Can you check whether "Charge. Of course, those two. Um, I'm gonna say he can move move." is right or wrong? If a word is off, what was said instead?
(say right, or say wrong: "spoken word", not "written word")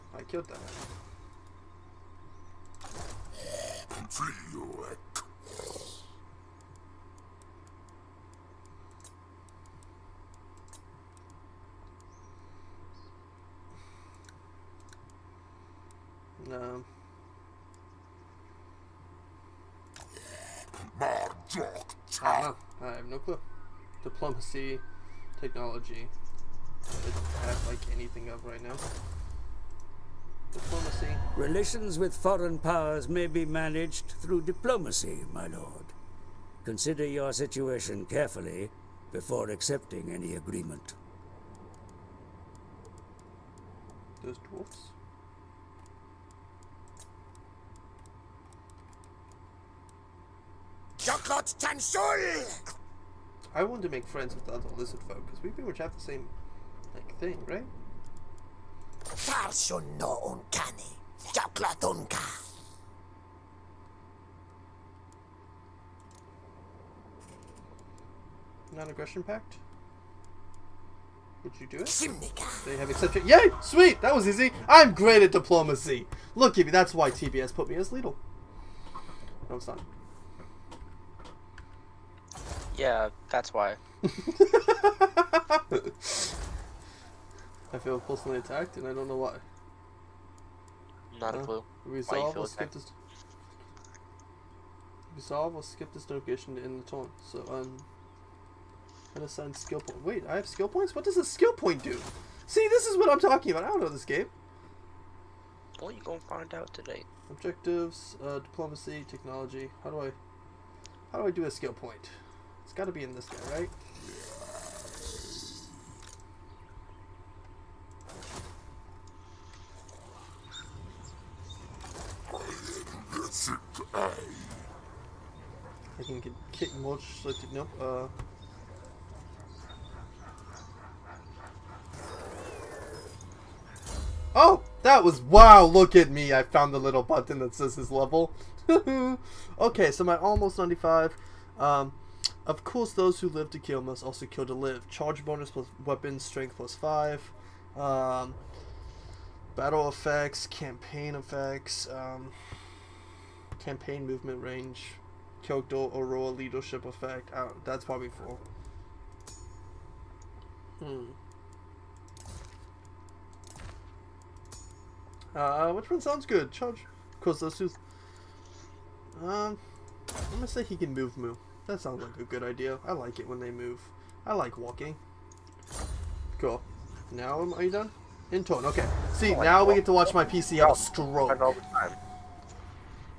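right.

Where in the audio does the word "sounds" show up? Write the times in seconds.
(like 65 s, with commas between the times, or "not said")
166 s, 171 s.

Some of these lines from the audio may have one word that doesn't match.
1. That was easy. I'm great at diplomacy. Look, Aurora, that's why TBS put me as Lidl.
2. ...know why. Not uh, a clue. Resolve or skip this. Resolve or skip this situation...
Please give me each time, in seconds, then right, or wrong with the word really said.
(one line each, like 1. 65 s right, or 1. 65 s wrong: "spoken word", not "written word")
1. 74 s wrong: "Gibby", not "Aurora"
2. 89 s wrong: "location", not "situation".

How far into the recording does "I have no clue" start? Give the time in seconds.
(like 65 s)
22 s.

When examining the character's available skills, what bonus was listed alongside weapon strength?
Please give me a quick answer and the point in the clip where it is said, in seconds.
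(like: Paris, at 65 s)
Charge bonus, at 144 s.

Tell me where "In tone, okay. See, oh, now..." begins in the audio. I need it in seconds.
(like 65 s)
178 s.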